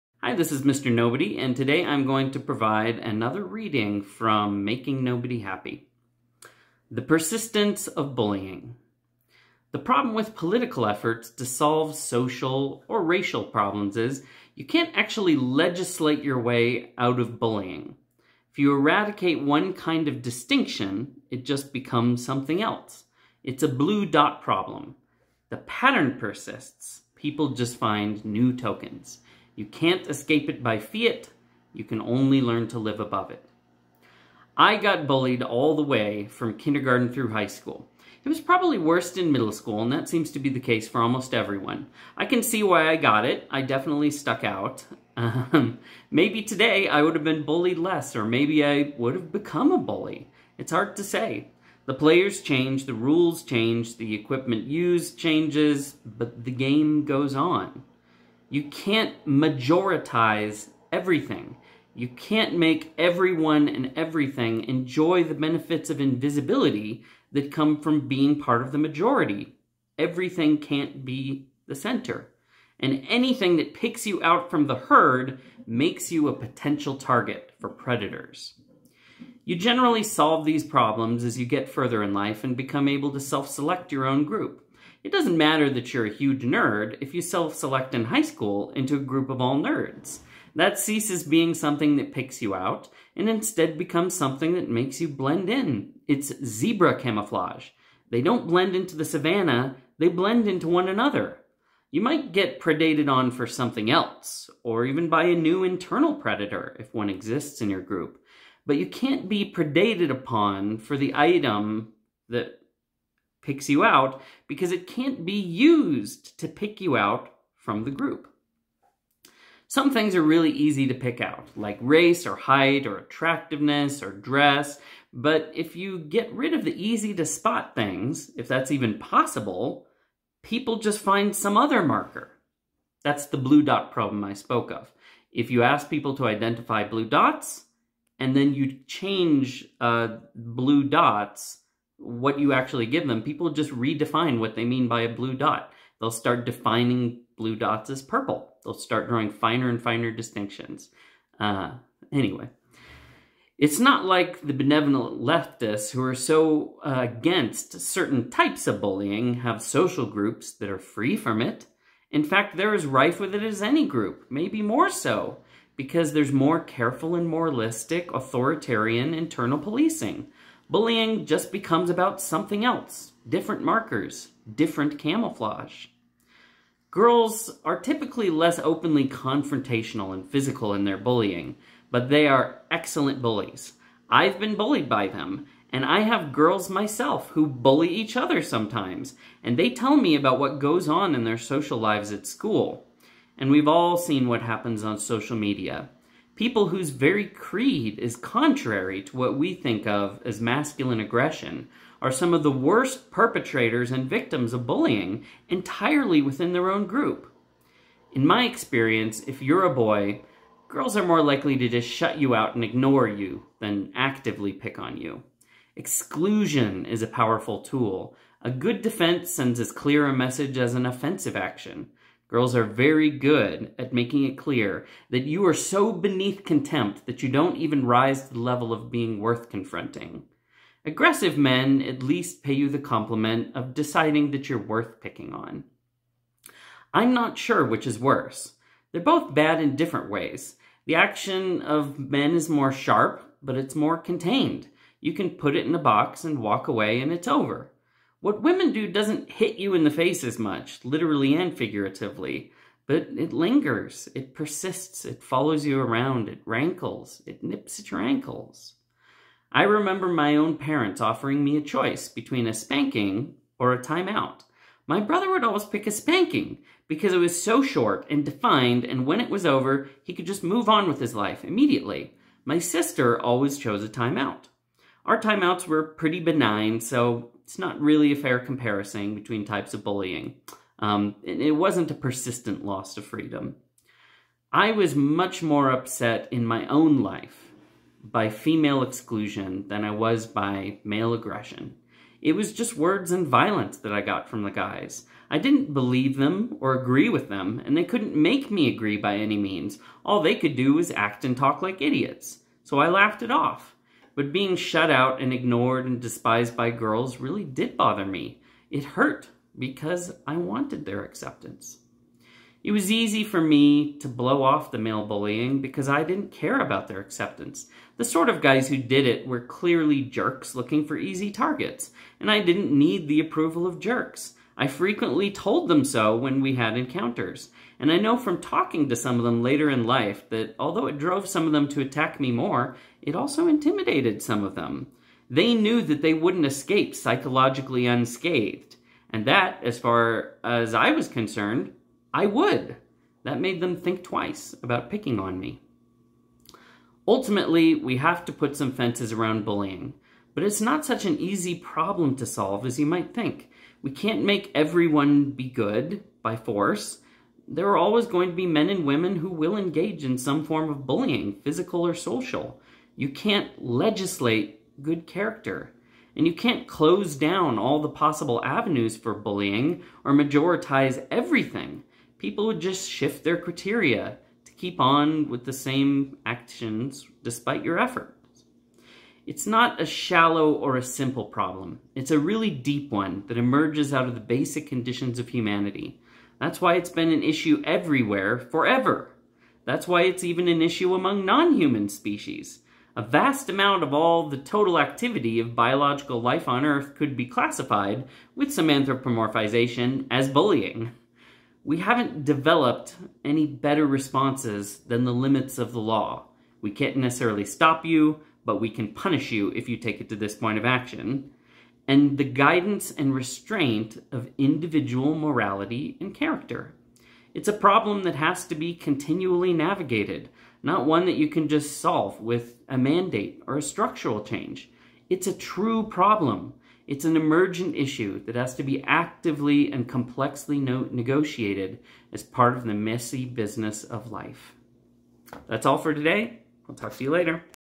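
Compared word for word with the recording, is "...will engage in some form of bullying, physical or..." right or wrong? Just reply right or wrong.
right.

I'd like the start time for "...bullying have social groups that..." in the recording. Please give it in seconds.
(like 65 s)
158 s.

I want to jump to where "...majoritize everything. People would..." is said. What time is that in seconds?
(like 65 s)
370 s.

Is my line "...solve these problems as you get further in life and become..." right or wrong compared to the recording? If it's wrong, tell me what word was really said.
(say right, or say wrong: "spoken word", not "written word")
right.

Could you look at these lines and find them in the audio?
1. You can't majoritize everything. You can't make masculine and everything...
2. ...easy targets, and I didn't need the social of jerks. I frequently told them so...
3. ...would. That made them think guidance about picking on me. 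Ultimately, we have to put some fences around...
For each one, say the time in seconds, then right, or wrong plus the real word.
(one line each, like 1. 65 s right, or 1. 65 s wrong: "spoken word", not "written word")
1. 58 s wrong: "everyone", not "masculine"
2. 320 s wrong: "approval", not "social"
3. 342 s wrong: "twice", not "guidance".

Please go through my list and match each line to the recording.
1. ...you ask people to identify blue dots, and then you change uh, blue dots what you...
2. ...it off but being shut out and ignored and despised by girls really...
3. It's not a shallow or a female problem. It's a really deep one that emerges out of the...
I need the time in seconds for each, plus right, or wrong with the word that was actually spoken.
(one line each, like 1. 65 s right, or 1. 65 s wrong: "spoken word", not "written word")
1. 135 s right
2. 303 s right
3. 379 s wrong: "simple", not "female".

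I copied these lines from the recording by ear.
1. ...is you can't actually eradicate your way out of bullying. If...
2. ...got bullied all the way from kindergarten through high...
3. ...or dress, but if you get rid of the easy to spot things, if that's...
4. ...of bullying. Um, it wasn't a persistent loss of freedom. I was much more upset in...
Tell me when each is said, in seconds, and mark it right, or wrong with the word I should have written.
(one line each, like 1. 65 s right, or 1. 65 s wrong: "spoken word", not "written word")
1. 13 s wrong: "legislate", not "eradicate"
2. 34 s right
3. 124 s right
4. 279 s right.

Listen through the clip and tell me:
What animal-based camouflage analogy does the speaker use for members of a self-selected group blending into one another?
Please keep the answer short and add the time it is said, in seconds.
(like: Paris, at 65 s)
Zebra camouflage, at 96 s.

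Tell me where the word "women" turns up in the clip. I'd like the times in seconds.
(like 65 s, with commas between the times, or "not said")
248 s, 358 s.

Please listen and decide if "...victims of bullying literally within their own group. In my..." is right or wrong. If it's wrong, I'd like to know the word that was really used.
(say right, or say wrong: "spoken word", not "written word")
wrong: "entirely", not "literally".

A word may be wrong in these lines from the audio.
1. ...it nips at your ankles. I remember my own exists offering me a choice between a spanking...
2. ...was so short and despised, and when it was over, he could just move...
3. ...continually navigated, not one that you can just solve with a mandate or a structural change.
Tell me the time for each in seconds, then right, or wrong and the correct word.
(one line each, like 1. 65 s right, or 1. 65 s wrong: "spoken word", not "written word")
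1. 257 s wrong: "parents", not "exists"
2. 267 s wrong: "defined", not "despised"
3. 418 s right.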